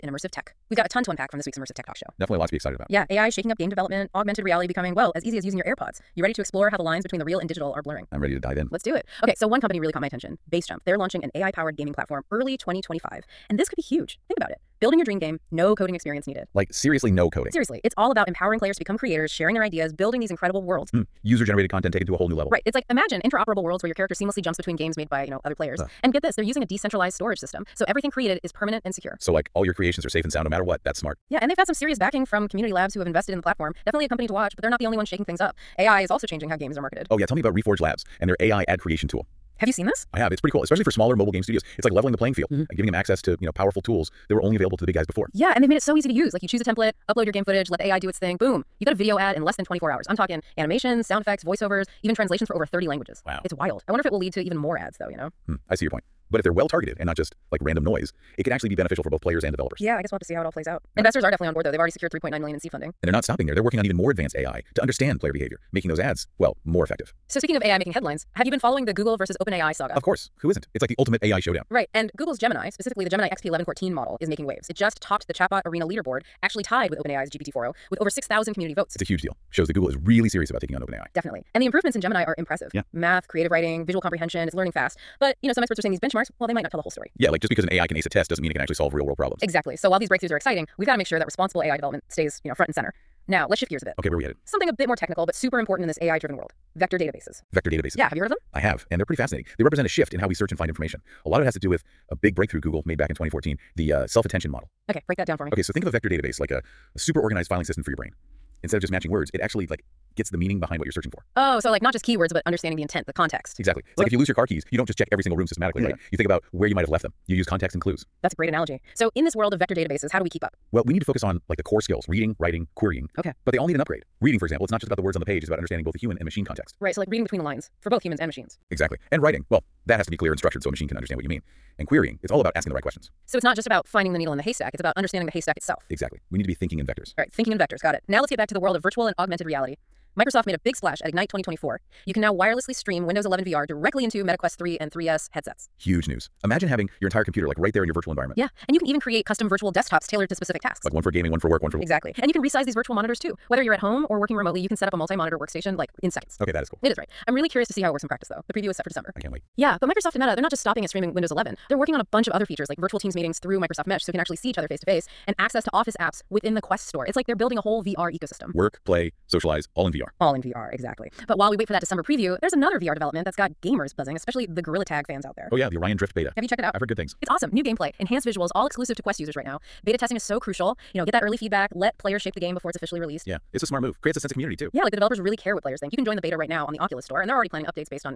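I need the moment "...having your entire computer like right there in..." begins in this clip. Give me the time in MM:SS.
02:26.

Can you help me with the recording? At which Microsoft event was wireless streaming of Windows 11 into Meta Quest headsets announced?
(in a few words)
Ignite 2024.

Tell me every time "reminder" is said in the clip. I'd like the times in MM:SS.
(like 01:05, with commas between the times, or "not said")
not said.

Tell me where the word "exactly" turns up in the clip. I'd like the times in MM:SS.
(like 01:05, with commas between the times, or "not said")
01:29, 01:53, 02:08, 02:15, 02:31, 02:50.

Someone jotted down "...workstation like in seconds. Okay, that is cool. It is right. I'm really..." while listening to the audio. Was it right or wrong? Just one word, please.
right.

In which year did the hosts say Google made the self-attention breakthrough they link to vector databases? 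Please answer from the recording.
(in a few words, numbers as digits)
2014.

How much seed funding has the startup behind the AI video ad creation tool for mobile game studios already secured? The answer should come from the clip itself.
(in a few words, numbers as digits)
$3.9 million.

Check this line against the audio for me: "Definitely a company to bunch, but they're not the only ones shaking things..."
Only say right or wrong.
wrong.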